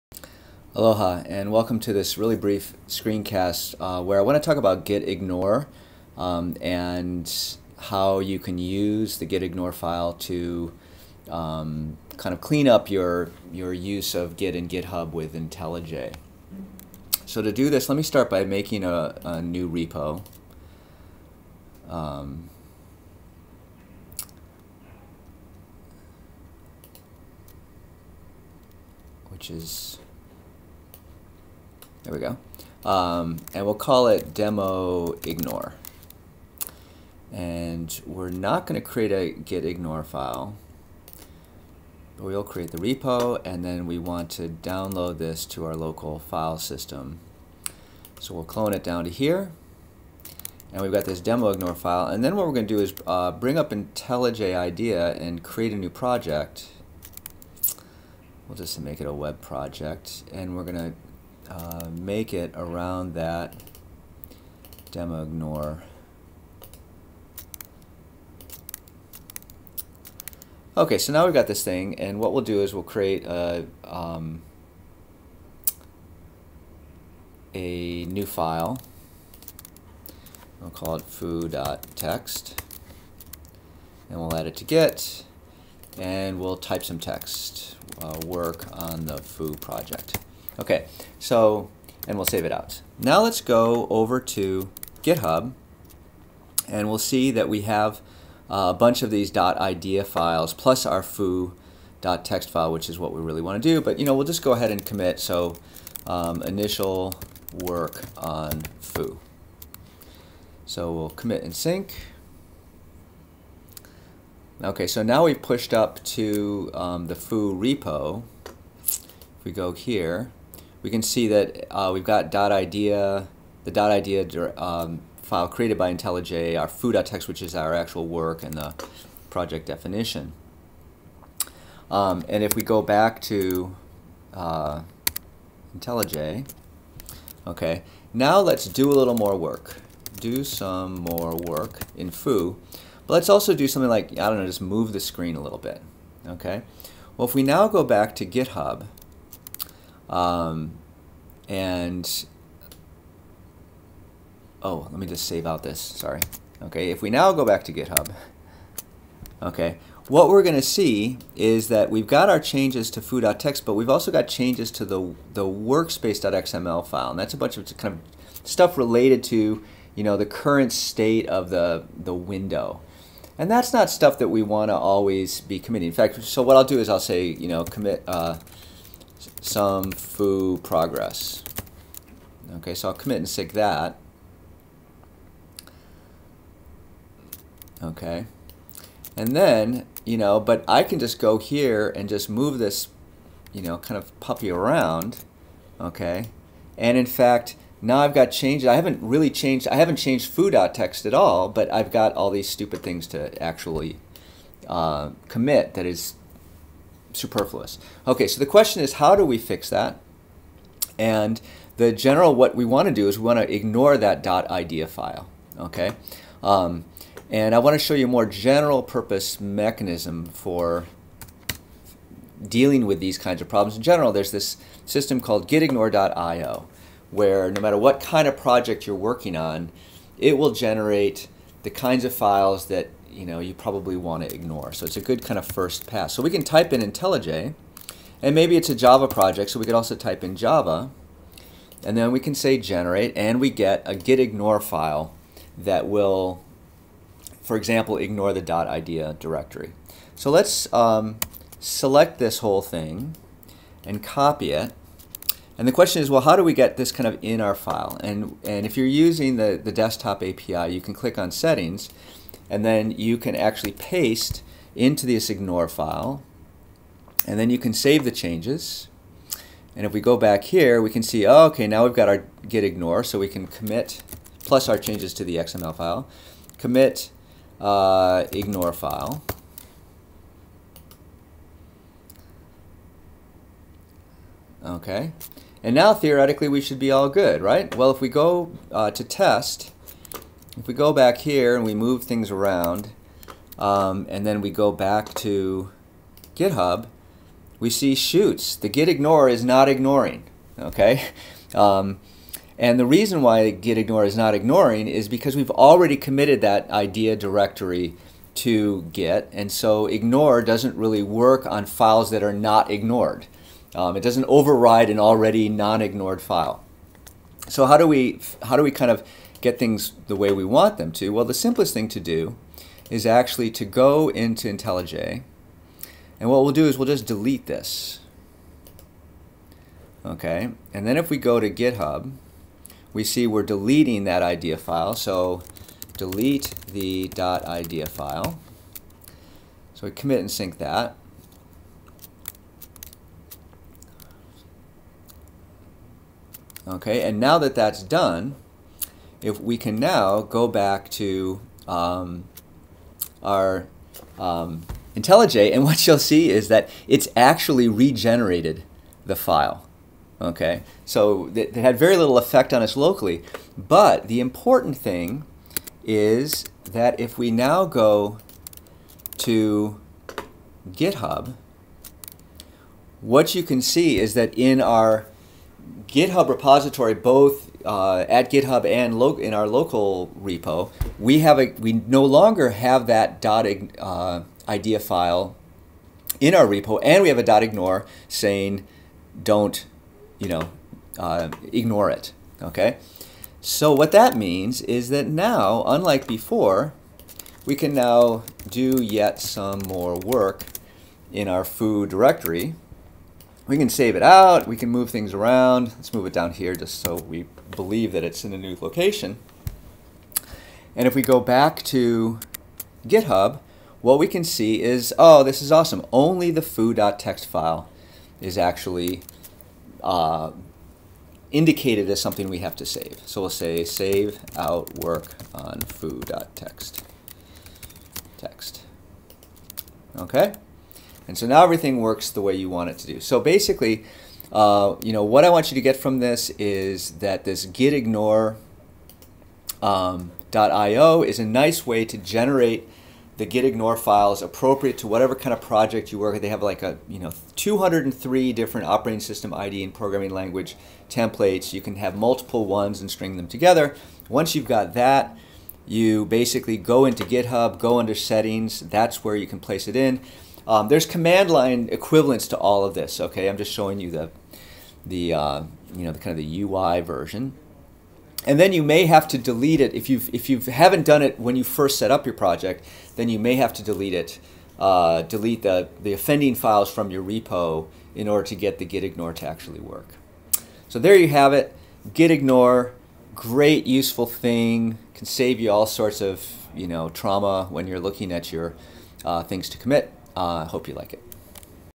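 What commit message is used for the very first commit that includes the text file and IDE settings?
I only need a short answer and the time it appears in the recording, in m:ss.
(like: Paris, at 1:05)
initial work on foo, at 1:46.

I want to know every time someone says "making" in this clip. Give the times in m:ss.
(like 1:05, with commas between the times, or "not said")
0:18.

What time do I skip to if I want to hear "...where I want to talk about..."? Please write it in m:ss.
0:04.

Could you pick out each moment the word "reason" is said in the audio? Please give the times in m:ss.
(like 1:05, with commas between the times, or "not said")
5:02.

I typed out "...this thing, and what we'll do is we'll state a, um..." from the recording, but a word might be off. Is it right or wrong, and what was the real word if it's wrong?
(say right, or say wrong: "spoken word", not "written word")
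wrong: "create", not "state".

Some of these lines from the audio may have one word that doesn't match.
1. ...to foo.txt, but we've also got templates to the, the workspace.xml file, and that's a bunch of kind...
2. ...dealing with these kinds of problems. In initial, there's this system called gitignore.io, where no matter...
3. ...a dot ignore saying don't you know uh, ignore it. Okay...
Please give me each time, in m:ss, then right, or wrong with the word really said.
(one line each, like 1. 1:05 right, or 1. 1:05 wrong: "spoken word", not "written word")
1. 2:42 wrong: "changes", not "templates"
2. 3:42 wrong: "general", not "initial"
3. 6:27 right.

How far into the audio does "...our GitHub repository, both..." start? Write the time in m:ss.
6:14.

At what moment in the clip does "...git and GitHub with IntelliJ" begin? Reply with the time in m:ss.
0:14.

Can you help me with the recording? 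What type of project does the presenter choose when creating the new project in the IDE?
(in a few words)
web project.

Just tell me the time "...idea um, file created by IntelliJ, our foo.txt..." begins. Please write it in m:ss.
2:03.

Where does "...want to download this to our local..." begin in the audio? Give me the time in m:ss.
0:43.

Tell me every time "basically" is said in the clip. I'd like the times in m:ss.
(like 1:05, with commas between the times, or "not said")
7:13, 7:36.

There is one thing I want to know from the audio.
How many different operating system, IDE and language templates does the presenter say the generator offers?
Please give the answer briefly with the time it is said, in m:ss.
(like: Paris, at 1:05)
203, at 7:27.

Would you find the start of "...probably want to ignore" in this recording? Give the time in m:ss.
3:53.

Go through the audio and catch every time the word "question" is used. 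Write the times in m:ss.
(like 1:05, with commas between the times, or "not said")
3:28, 4:15.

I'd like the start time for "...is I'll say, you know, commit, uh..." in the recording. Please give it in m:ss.
2:56.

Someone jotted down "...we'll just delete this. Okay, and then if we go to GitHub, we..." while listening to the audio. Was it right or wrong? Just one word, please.
right.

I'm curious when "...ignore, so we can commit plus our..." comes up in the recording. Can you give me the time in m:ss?
4:32.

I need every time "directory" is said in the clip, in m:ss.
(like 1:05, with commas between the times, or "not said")
4:09, 5:07, 6:41.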